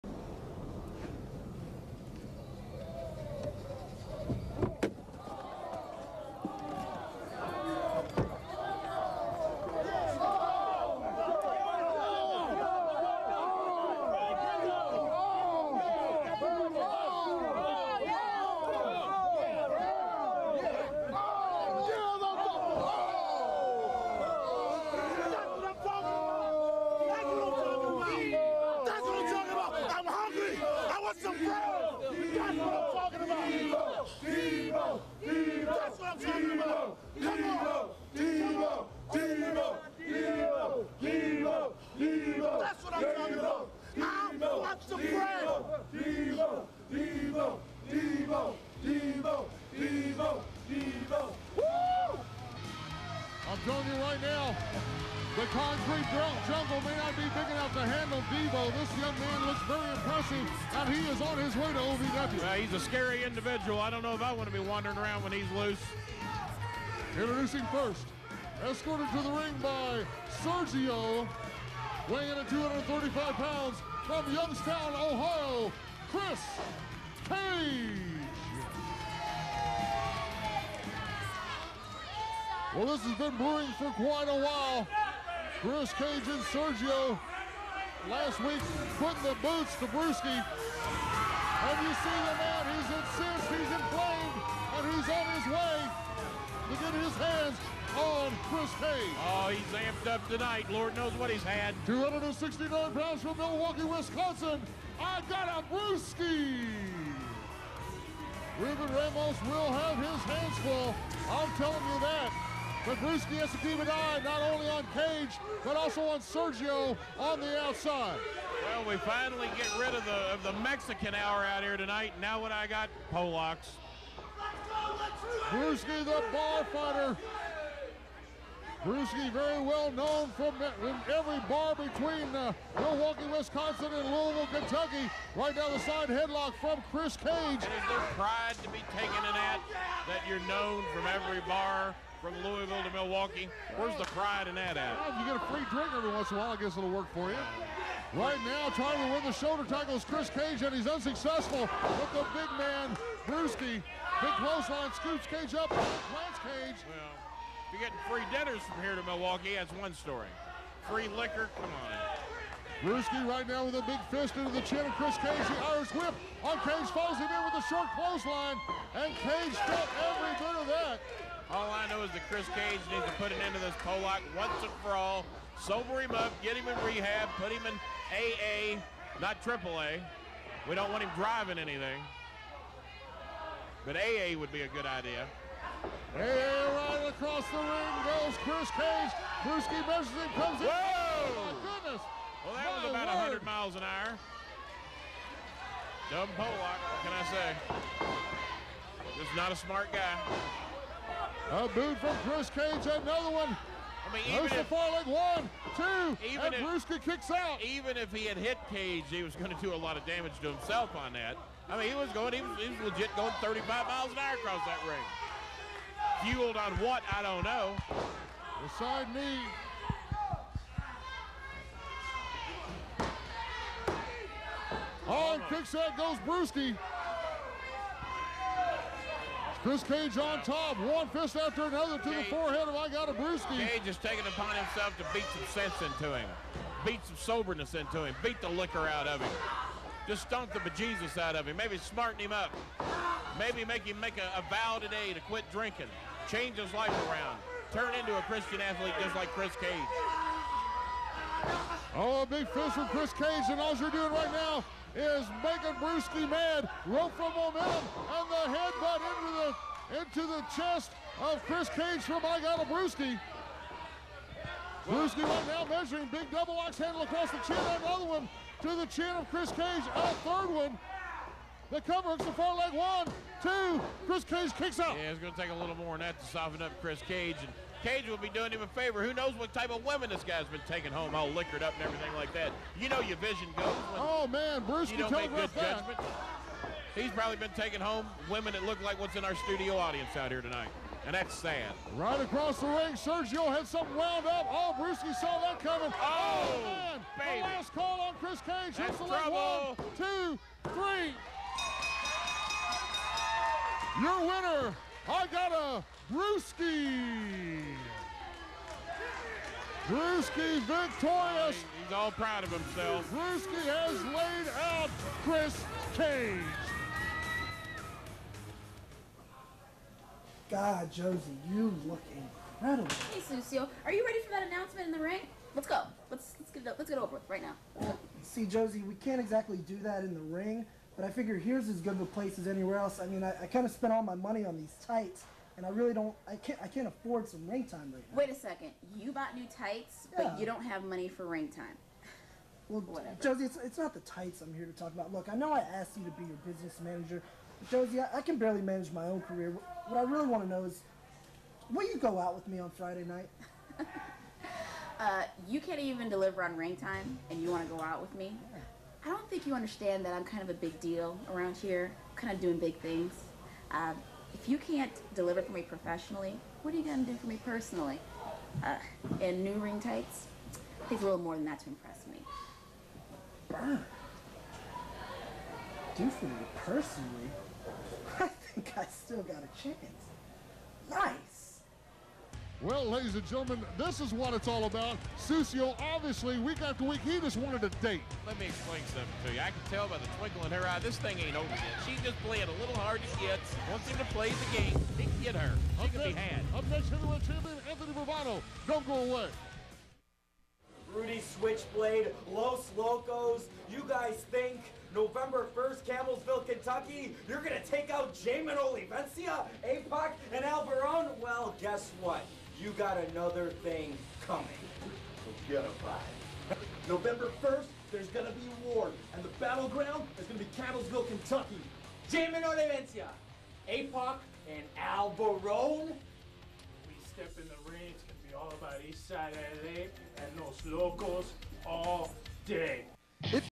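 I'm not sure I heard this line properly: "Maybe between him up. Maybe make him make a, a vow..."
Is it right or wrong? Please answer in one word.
wrong.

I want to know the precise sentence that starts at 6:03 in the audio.
Uh, if you can't deliver for me professionally, what are you going to do for me personally?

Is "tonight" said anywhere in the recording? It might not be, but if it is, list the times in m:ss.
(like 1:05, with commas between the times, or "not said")
1:40, 2:01, 4:50.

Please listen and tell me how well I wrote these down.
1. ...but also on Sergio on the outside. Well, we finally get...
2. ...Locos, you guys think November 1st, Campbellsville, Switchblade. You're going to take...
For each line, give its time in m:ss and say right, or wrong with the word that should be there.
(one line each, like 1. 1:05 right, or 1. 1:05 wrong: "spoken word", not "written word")
1. 1:55 right
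2. 6:42 wrong: "Kentucky", not "Switchblade".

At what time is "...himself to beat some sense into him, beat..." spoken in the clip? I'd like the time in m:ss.
3:54.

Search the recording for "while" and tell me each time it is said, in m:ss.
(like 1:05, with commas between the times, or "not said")
1:24, 2:26.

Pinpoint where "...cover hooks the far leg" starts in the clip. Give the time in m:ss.
4:31.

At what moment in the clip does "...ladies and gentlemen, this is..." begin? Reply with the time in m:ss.
6:22.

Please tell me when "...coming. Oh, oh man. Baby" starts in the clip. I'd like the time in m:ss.
4:55.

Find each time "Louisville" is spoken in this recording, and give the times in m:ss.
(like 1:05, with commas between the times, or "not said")
2:14, 2:22.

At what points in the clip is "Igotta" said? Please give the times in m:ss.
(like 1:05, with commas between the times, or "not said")
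1:44, 3:52, 4:22, 5:05.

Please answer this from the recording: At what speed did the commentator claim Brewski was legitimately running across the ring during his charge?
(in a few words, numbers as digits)
35 miles an hour.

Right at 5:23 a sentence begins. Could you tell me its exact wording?
Hey, Sucio, are you ready for that announcement in the ring?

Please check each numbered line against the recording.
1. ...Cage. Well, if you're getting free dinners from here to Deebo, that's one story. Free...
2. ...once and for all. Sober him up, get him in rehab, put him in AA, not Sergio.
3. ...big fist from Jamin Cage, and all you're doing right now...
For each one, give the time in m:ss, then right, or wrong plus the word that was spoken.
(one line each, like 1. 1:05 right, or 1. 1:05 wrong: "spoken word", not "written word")
1. 2:36 wrong: "Milwaukee", not "Deebo"
2. 2:54 wrong: "AAA", not "Sergio"
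3. 4:12 wrong: "Chris", not "Jamin".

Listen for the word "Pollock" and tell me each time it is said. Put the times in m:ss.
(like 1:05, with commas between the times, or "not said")
2:53, 3:16.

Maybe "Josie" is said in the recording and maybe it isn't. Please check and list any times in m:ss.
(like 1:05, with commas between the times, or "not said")
5:20, 5:28, 5:43, 5:47.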